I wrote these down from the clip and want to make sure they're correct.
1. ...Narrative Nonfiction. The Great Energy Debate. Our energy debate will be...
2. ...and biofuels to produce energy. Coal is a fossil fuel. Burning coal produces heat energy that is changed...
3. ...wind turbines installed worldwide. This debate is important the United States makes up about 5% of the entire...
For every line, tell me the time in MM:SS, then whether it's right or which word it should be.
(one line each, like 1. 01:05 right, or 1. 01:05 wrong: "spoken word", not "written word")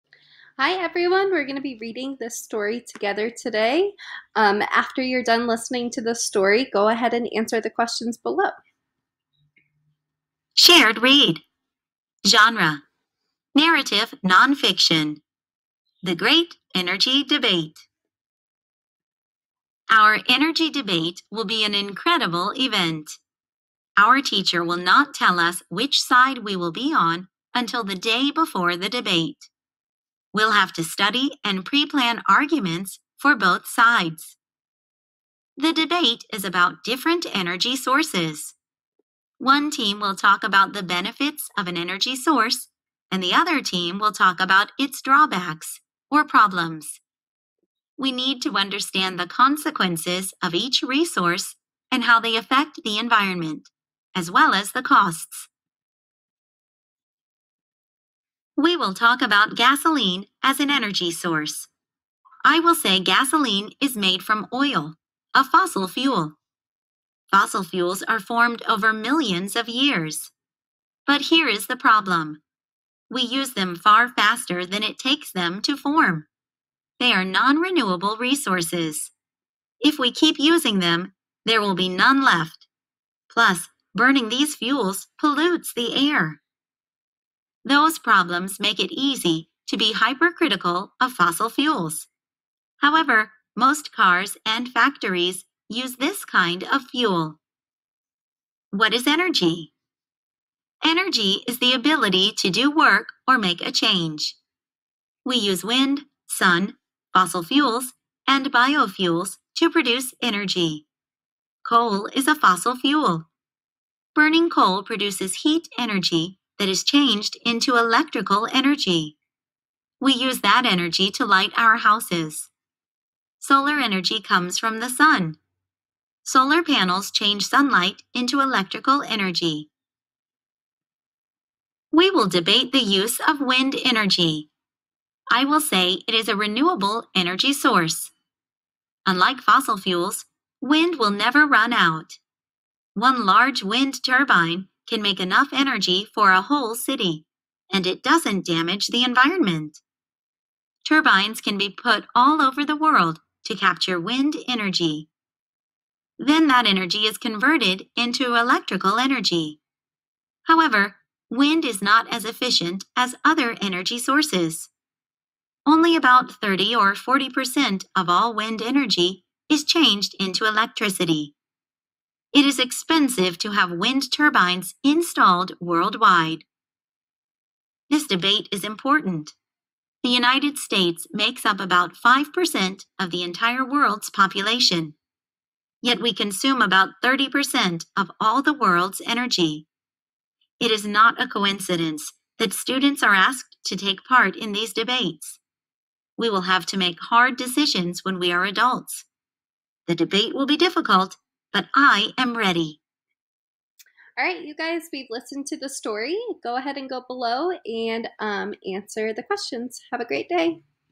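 1. 00:13 right
2. 01:48 right
3. 02:53 right.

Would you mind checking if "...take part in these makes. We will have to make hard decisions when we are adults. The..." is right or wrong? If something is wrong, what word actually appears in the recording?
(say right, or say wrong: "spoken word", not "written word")
wrong: "debates", not "makes".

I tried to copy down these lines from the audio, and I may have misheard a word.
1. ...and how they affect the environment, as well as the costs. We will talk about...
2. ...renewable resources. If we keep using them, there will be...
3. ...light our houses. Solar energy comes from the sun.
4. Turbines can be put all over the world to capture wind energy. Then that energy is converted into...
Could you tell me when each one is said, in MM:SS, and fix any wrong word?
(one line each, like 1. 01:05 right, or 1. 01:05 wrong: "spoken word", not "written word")
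1. 00:51 right
2. 01:17 right
3. 02:01 right
4. 02:30 right.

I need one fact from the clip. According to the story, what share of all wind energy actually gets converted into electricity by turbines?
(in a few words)
30 or 40%.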